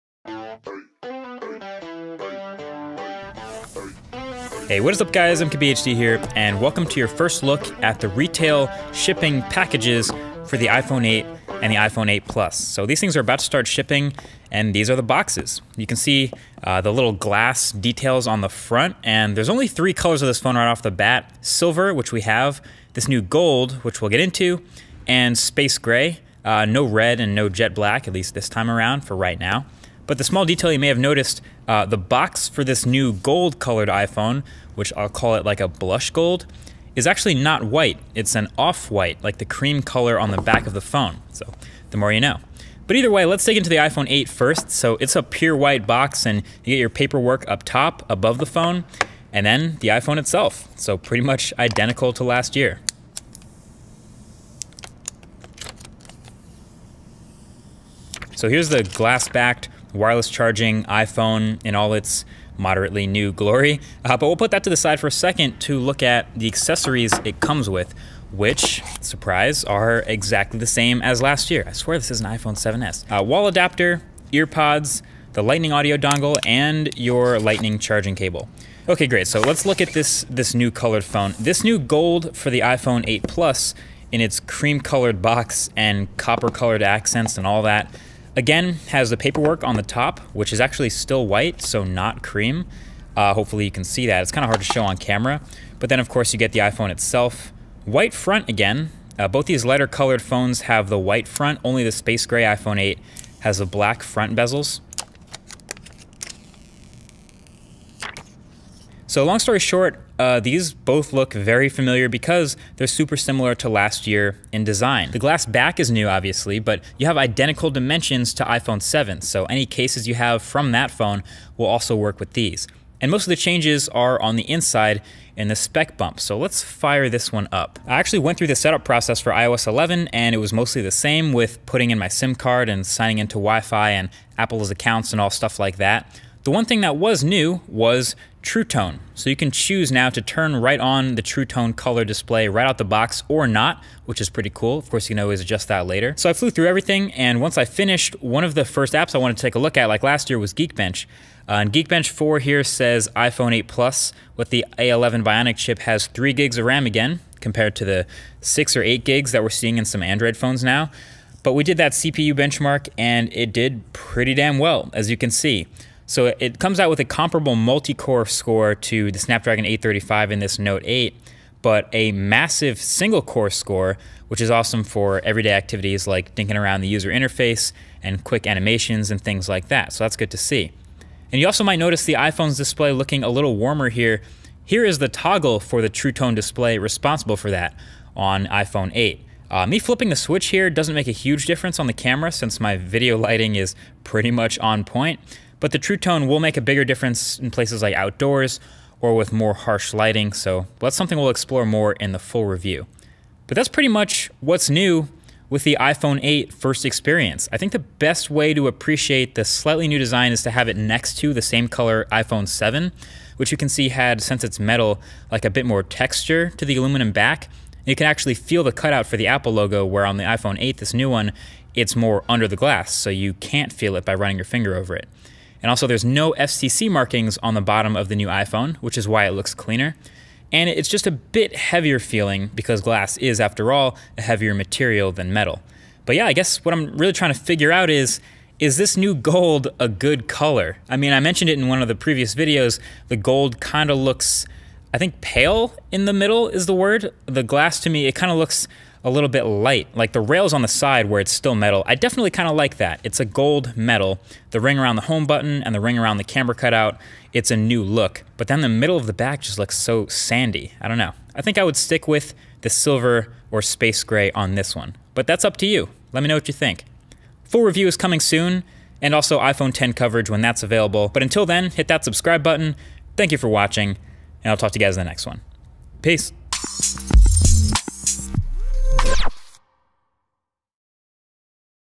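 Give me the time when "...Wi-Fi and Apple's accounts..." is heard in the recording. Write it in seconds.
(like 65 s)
133 s.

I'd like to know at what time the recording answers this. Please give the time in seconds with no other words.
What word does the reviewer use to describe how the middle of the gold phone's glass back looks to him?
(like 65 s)
260 s.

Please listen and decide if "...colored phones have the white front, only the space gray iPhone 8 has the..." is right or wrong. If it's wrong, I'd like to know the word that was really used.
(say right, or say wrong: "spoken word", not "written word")
right.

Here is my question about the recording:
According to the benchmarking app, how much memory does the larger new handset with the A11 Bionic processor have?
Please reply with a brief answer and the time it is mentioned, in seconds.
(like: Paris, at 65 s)
3 gigs, at 156 s.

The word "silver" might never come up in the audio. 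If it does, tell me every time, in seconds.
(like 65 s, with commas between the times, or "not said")
21 s, 262 s.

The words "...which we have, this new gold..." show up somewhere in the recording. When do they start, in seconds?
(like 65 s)
21 s.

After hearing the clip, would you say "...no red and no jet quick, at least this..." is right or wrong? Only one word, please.
wrong.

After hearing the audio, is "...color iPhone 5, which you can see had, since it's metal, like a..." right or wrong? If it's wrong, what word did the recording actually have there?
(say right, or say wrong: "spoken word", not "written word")
wrong: "7", not "5".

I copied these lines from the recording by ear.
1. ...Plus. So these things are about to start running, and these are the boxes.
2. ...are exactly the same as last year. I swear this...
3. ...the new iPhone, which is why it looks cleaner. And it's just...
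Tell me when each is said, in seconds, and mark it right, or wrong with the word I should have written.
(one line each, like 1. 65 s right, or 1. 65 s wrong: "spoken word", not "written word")
1. 12 s wrong: "shipping", not "running"
2. 69 s right
3. 228 s right.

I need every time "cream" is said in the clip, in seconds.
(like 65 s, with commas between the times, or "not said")
39 s, 84 s, 92 s.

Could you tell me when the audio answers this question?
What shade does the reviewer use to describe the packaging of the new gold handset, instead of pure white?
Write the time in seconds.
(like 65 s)
38 s.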